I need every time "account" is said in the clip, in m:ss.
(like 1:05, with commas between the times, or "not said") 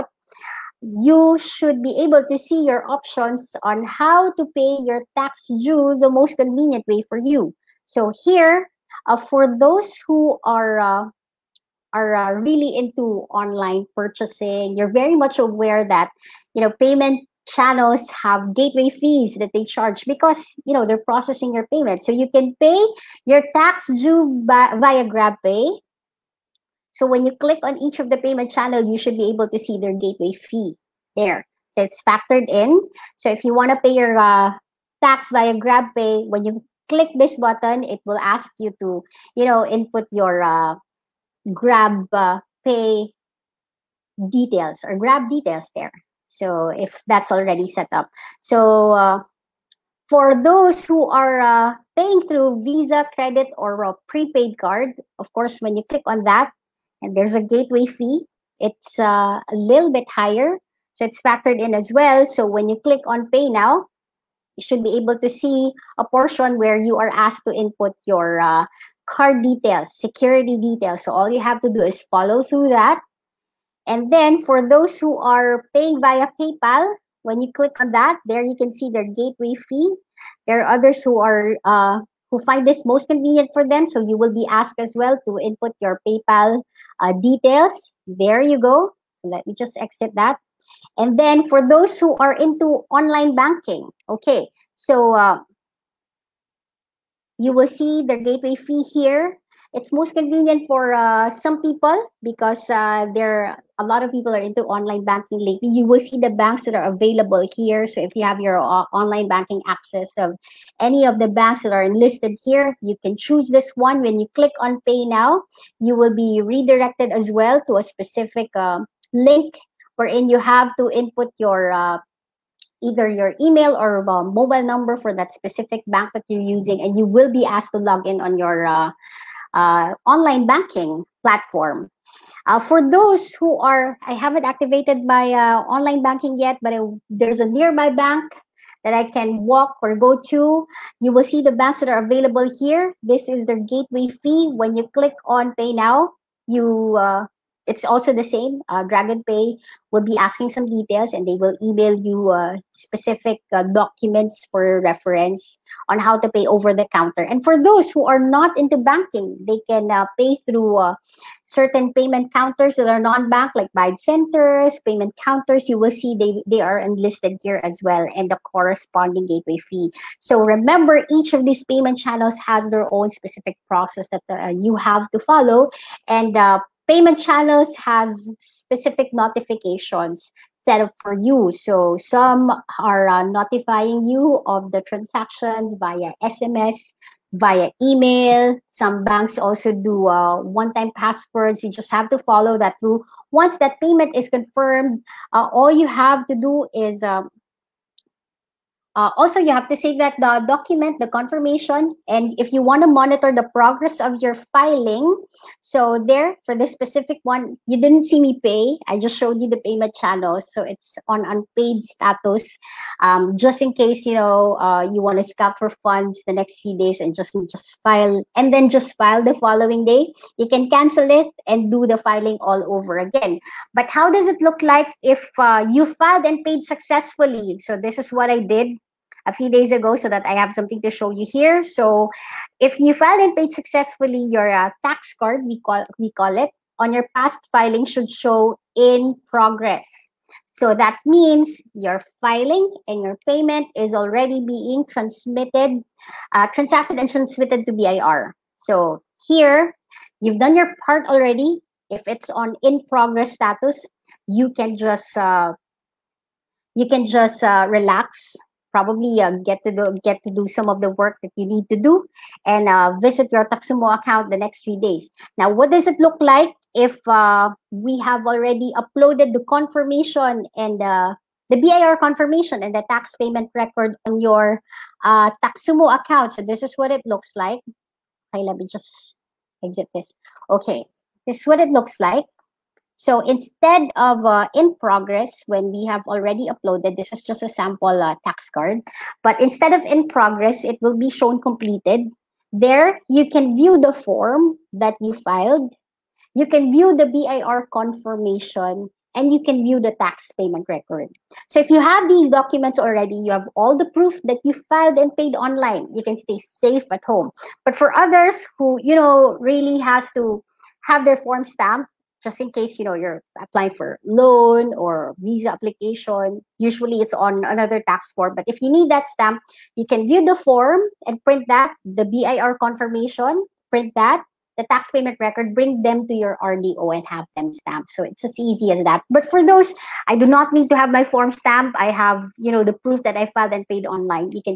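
4:23, 4:35.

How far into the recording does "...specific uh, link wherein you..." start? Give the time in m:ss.
1:57.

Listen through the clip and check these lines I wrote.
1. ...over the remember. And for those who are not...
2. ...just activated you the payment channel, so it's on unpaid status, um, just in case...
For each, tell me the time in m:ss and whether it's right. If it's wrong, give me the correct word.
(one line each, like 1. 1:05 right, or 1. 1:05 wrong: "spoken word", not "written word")
1. 2:36 wrong: "counter", not "remember"
2. 3:29 wrong: "showed", not "activated".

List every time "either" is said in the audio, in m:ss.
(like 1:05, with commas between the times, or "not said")
2:02.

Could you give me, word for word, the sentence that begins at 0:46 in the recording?
So if that's already set up.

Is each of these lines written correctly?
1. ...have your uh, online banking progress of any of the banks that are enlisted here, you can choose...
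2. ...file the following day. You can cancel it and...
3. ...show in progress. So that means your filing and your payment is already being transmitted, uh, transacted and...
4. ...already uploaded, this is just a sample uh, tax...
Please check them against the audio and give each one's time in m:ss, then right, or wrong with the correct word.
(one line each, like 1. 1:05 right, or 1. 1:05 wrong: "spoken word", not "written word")
1. 1:48 wrong: "access", not "progress"
2. 3:38 right
3. 3:58 right
4. 4:46 right.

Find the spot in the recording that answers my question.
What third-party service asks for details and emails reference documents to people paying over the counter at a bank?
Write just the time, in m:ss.
2:28.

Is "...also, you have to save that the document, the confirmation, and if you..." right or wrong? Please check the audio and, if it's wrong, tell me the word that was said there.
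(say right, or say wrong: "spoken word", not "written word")
right.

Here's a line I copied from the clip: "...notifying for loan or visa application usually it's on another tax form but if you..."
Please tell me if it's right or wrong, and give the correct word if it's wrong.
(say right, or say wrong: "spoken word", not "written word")
wrong: "applying", not "notifying".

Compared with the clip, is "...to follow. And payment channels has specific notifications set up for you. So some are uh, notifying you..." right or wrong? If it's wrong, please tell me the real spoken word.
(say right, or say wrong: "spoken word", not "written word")
right.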